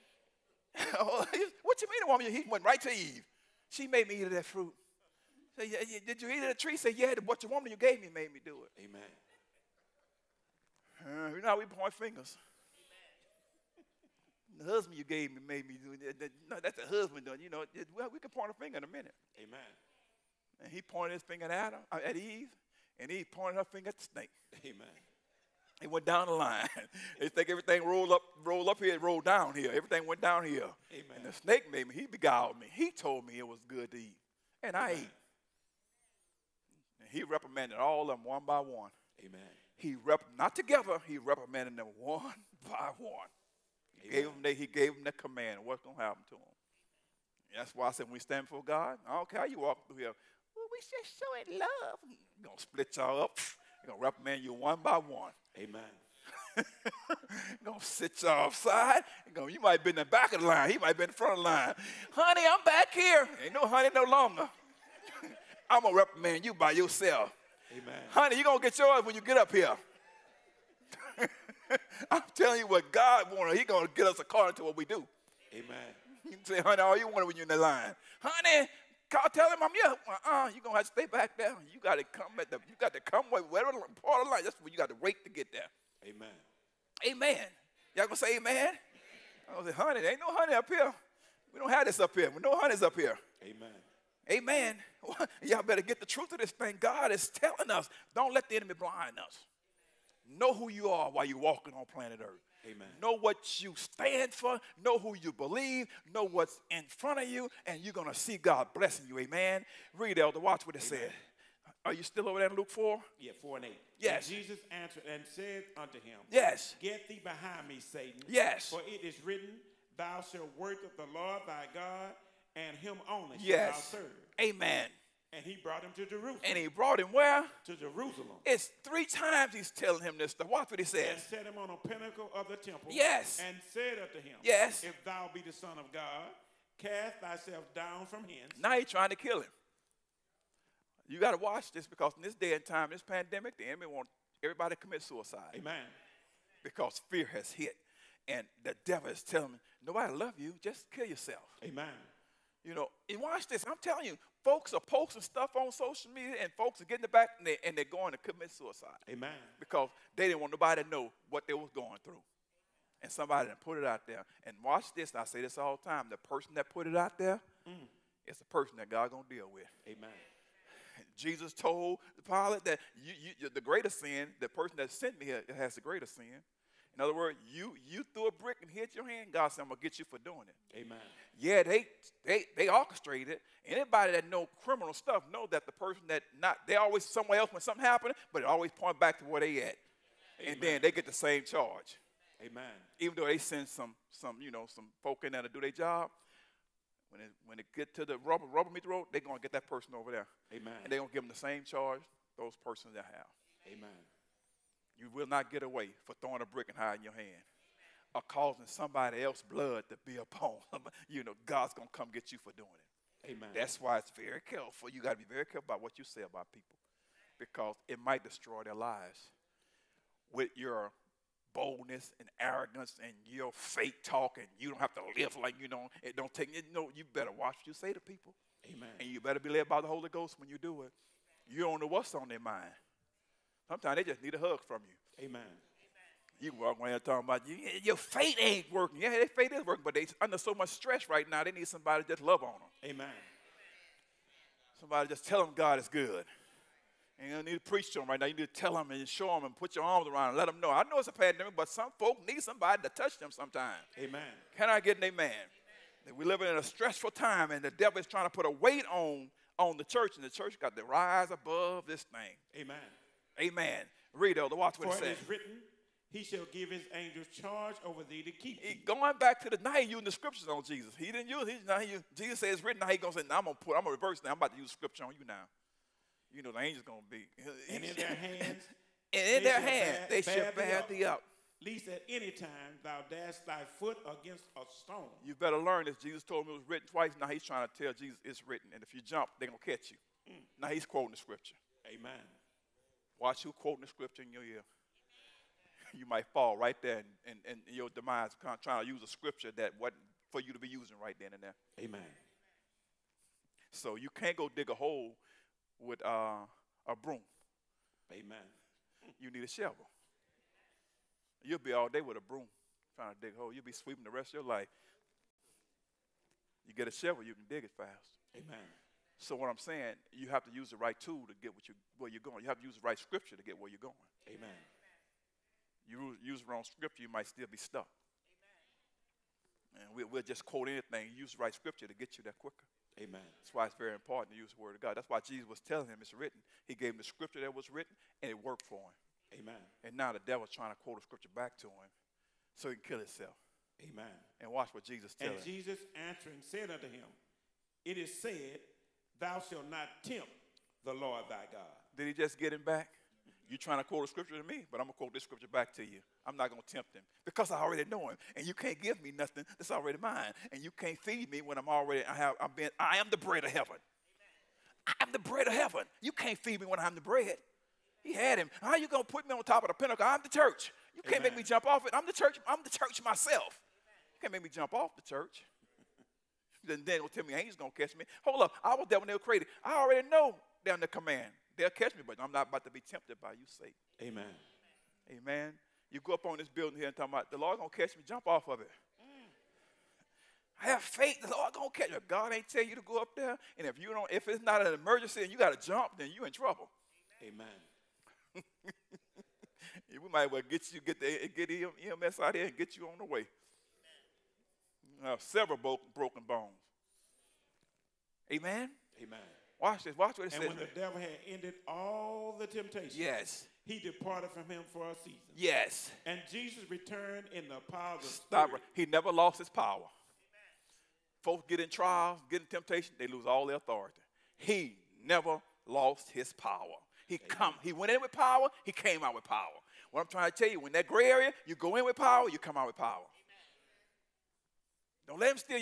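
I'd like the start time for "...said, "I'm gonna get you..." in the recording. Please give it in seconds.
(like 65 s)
179 s.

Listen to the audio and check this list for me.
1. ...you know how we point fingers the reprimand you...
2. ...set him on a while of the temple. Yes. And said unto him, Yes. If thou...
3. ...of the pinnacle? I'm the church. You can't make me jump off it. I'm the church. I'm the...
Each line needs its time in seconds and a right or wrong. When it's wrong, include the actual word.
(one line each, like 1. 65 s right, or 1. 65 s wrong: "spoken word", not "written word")
1. 11 s wrong: "husband", not "reprimand"
2. 131 s wrong: "pinnacle", not "while"
3. 369 s right.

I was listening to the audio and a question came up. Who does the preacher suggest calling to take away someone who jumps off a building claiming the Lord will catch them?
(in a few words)
EMS.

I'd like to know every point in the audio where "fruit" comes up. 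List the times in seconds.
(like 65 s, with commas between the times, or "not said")
4 s.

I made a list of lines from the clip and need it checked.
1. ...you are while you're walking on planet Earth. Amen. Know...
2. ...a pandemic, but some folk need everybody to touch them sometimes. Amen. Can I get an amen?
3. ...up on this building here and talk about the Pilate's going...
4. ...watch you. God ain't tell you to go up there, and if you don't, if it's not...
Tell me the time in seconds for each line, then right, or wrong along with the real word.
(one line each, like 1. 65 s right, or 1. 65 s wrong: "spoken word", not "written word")
1. 100 s right
2. 251 s wrong: "somebody", not "everybody"
3. 386 s wrong: "Lord", not "Pilate"
4. 391 s wrong: "catch", not "watch".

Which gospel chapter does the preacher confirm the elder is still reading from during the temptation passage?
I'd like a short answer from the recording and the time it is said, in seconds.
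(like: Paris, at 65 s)
Luke 4, at 112 s.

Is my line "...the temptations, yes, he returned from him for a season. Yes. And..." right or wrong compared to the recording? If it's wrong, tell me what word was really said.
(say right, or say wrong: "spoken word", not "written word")
wrong: "departed", not "returned".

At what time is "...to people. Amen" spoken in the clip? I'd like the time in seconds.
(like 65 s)
227 s.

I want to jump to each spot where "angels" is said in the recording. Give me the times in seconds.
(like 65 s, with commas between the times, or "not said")
266 s, 276 s.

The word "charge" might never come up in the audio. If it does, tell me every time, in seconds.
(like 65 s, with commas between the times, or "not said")
191 s, 201 s, 267 s.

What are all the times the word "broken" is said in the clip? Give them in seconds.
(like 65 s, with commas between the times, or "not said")
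405 s.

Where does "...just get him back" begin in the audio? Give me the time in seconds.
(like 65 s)
352 s.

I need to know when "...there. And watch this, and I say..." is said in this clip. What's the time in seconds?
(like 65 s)
164 s.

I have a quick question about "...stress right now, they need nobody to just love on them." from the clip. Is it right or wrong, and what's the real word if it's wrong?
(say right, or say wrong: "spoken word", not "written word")
wrong: "somebody", not "nobody".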